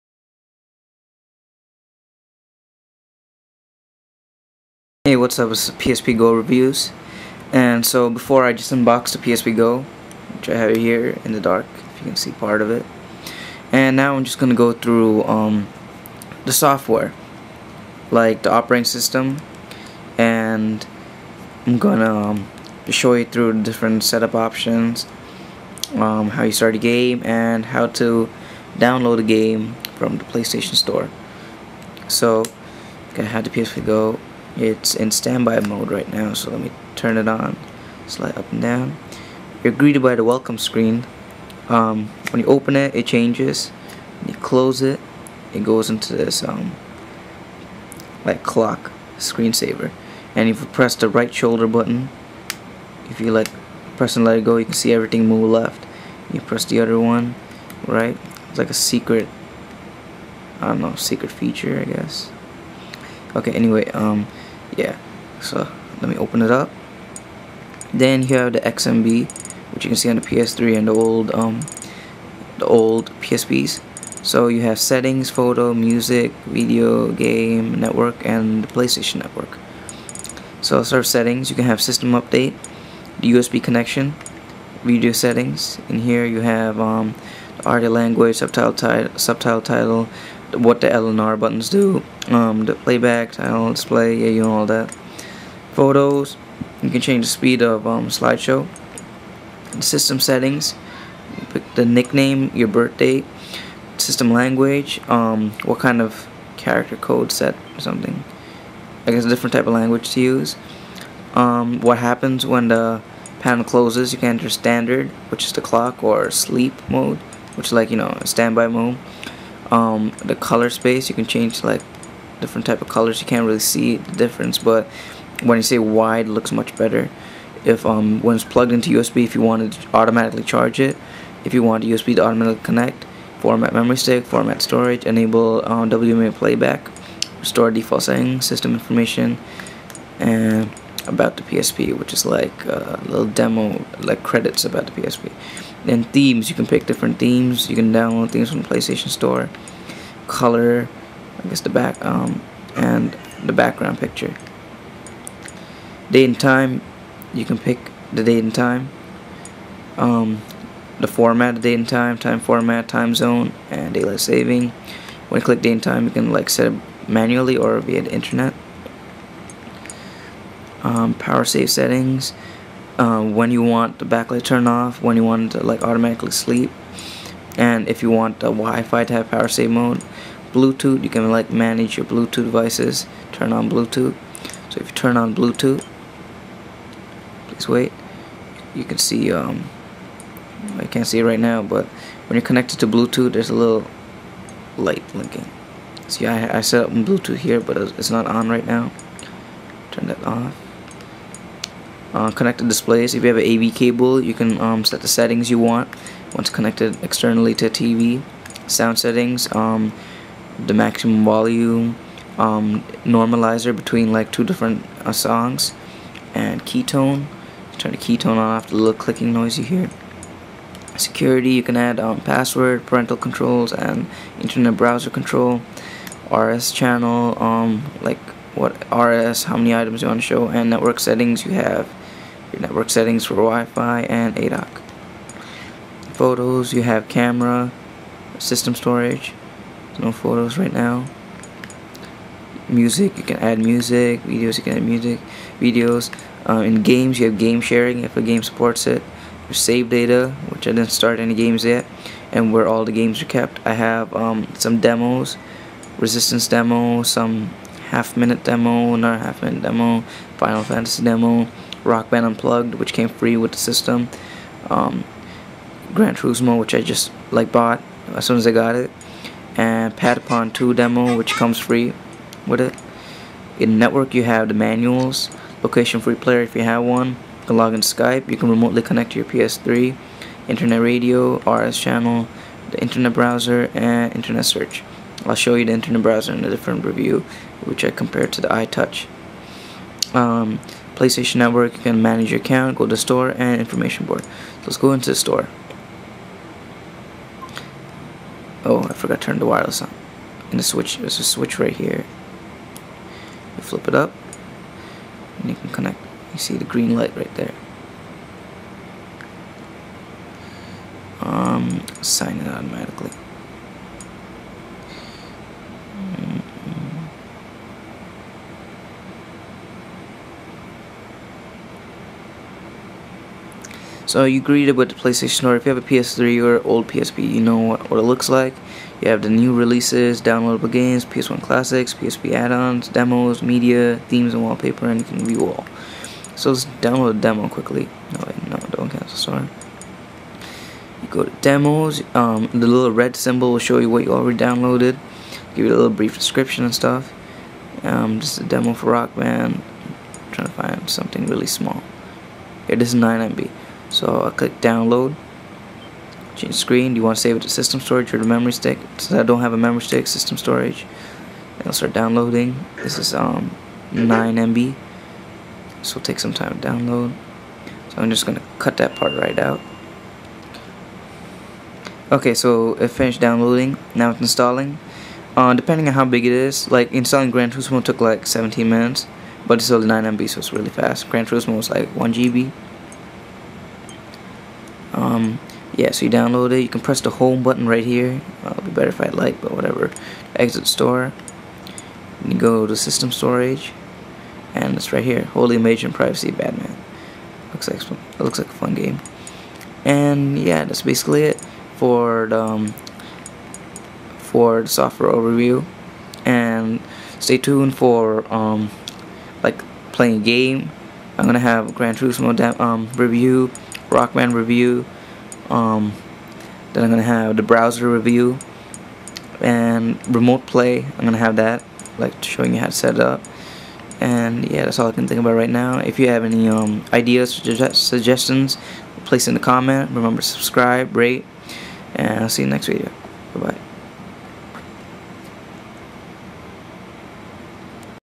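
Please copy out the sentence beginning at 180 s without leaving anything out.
Bluetooth, you can like manage your Bluetooth devices, turn on Bluetooth.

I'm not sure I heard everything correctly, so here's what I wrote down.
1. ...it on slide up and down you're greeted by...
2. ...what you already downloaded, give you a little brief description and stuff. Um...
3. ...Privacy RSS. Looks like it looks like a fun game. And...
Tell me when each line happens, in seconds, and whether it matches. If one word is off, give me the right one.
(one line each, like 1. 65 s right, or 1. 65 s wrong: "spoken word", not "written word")
1. 37 s right
2. 343 s right
3. 395 s wrong: "Batman", not "RSS".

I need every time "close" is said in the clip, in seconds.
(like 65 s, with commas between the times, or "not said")
44 s, 113 s.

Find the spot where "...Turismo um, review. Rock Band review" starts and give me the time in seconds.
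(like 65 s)
411 s.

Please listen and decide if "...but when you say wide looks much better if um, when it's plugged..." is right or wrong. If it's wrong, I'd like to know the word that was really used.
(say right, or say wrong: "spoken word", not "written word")
right.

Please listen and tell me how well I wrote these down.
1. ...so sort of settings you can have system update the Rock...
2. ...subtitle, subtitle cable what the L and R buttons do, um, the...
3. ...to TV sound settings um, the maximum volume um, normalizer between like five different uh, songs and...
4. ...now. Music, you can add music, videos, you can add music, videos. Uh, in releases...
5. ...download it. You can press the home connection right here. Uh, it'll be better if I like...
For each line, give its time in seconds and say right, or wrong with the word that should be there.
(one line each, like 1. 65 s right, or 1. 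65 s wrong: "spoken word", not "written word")
1. 80 s wrong: "USB", not "Rock"
2. 88 s wrong: "title", not "cable"
3. 207 s wrong: "two", not "five"
4. 240 s wrong: "games", not "releases"
5. 386 s wrong: "button", not "connection".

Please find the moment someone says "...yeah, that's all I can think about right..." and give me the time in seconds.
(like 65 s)
424 s.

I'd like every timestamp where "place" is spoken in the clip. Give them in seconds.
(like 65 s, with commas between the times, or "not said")
429 s.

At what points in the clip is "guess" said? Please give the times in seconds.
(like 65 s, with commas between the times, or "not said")
61 s, 109 s, 151 s.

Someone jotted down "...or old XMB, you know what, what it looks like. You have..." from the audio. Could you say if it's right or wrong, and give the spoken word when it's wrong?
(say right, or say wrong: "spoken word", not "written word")
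wrong: "PSP", not "XMB".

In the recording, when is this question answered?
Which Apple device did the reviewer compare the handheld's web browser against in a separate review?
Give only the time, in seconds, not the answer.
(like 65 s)
288 s.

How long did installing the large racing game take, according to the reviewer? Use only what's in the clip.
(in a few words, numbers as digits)
17 minutes.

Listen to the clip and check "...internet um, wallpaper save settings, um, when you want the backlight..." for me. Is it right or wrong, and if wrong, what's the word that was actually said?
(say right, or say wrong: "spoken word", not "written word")
wrong: "power", not "wallpaper".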